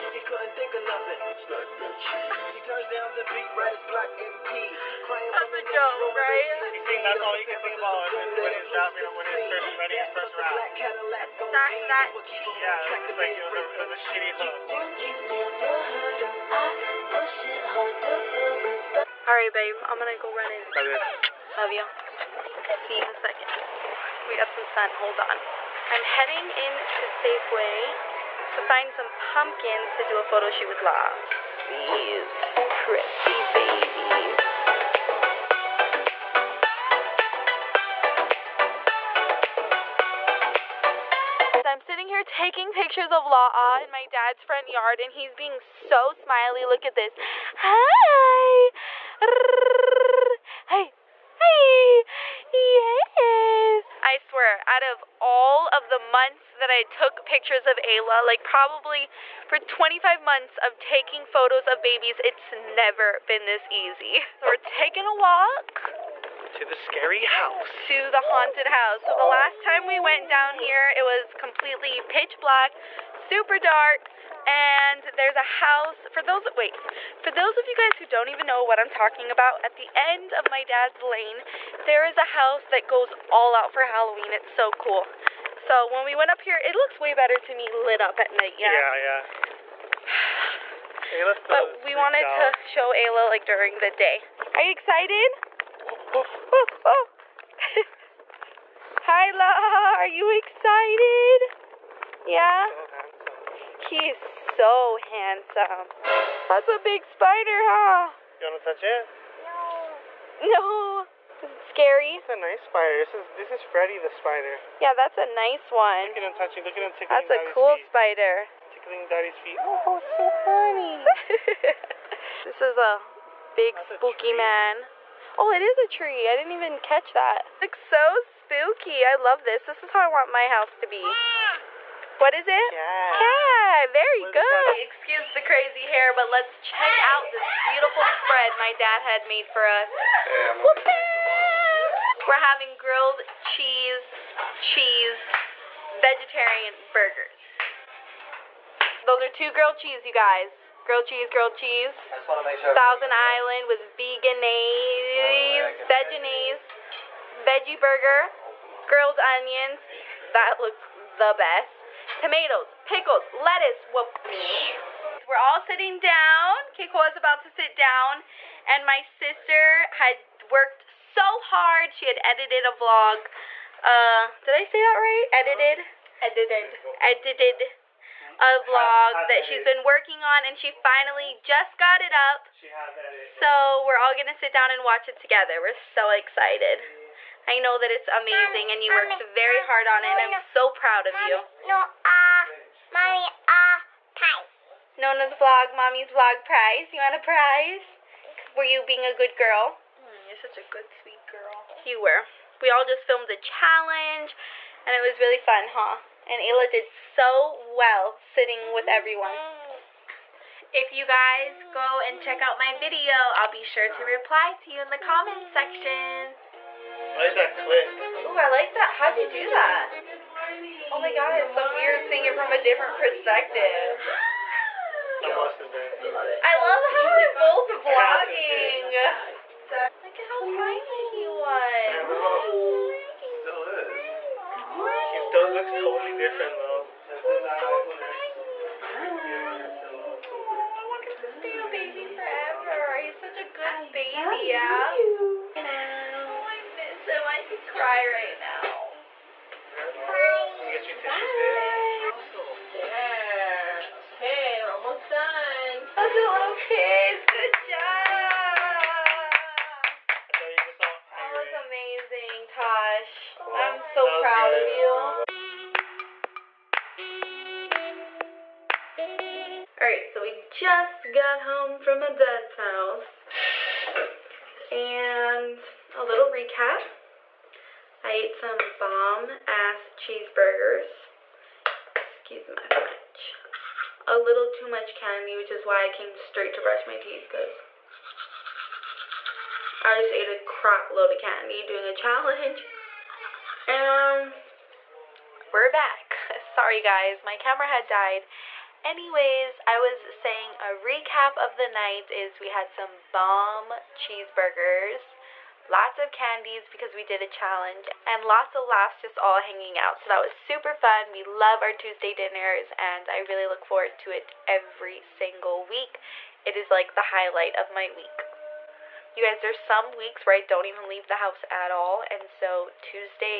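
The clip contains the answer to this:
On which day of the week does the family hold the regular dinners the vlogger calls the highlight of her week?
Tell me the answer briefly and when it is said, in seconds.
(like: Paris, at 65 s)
Tuesday, at 311 s.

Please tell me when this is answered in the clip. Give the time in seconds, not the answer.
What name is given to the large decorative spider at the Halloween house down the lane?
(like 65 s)
113 s.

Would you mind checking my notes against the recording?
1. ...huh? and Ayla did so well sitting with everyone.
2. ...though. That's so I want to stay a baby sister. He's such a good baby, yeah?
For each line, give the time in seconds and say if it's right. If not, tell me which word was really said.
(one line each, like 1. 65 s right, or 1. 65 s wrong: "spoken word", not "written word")
1. 205 s right
2. 236 s wrong: "forever", not "sister".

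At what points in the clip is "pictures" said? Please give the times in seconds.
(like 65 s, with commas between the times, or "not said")
42 s, 57 s.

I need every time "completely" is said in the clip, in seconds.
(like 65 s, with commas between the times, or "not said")
71 s.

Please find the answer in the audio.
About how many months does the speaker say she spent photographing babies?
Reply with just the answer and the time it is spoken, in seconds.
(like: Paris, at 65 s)
25, at 59 s.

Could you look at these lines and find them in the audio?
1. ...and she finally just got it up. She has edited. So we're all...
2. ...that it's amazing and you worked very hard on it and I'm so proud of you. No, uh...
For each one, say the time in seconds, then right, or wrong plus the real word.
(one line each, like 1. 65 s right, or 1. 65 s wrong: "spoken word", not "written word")
1. 180 s right
2. 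187 s right.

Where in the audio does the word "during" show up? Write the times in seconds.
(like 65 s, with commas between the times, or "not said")
93 s.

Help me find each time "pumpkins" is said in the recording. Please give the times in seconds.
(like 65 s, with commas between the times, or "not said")
29 s.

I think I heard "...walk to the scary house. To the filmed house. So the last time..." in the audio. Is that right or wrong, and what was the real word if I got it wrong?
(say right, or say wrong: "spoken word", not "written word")
wrong: "haunted", not "filmed".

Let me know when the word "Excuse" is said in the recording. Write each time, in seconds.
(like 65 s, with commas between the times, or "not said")
134 s, 281 s.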